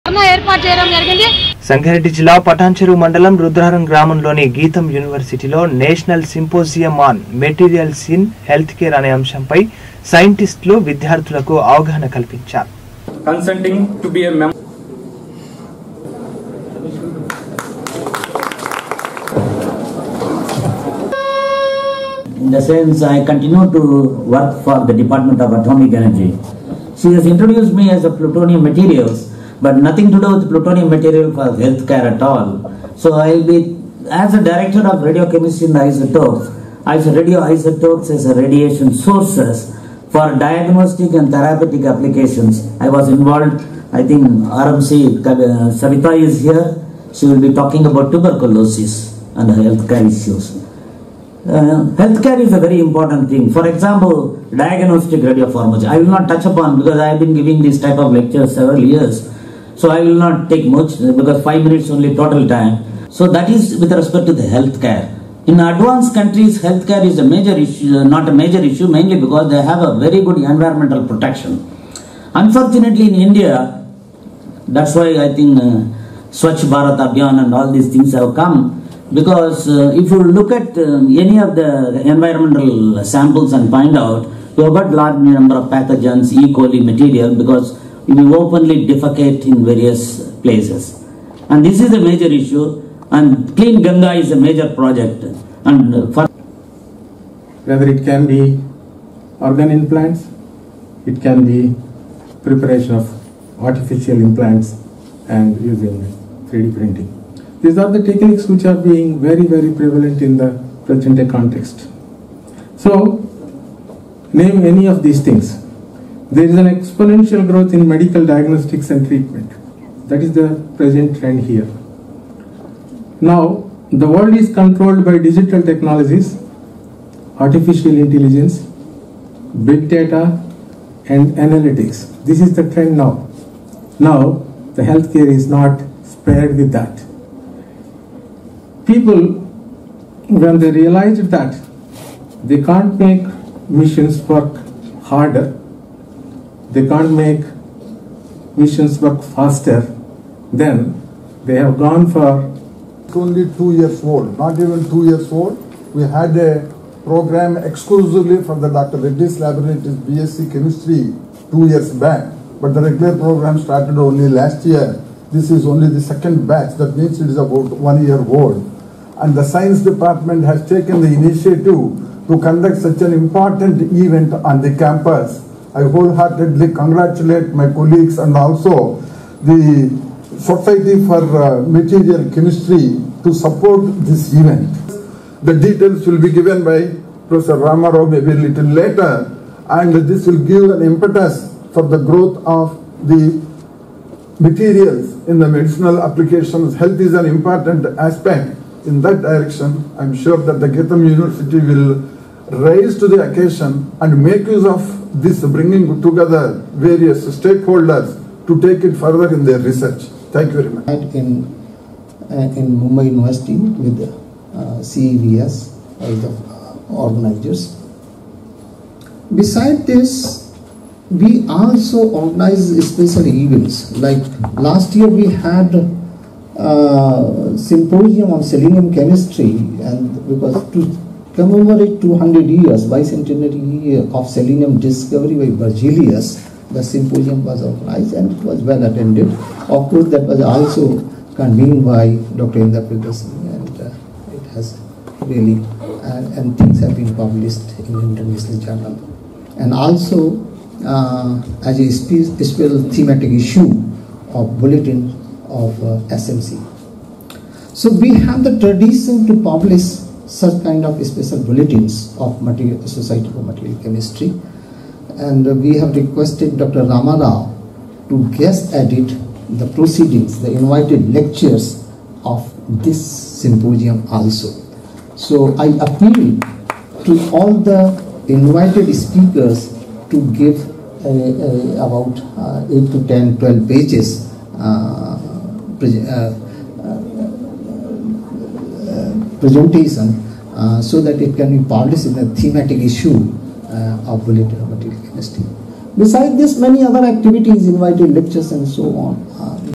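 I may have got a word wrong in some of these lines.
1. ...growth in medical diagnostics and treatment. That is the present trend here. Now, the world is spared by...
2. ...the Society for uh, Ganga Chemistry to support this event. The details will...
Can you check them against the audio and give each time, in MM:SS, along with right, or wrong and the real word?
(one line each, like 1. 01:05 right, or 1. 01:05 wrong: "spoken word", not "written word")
1. 01:57 wrong: "controlled", not "spared"
2. 02:59 wrong: "Material", not "Ganga".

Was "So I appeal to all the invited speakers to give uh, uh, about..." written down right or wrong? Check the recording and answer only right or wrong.
right.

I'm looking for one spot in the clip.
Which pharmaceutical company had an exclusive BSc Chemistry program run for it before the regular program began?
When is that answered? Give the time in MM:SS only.
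02:38.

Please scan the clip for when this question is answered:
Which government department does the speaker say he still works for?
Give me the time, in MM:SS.
00:25.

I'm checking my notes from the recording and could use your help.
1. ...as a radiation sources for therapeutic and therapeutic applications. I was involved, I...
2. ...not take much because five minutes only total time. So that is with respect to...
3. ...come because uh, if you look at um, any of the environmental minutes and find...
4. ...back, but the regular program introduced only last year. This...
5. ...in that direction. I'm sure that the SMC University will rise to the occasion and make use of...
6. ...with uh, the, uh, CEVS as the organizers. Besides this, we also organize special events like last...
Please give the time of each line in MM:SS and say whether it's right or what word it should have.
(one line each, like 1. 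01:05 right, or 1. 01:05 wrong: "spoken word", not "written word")
1. 00:38 wrong: "diagnostic", not "therapeutic"
2. 01:00 right
3. 01:18 wrong: "samples", not "minutes"
4. 02:41 wrong: "started", not "introduced"
5. 03:18 wrong: "GITAM", not "SMC"
6. 03:33 right.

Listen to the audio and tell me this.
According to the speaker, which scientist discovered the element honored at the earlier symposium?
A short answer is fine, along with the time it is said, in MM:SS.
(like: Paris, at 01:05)
Berzelius, at 03:55.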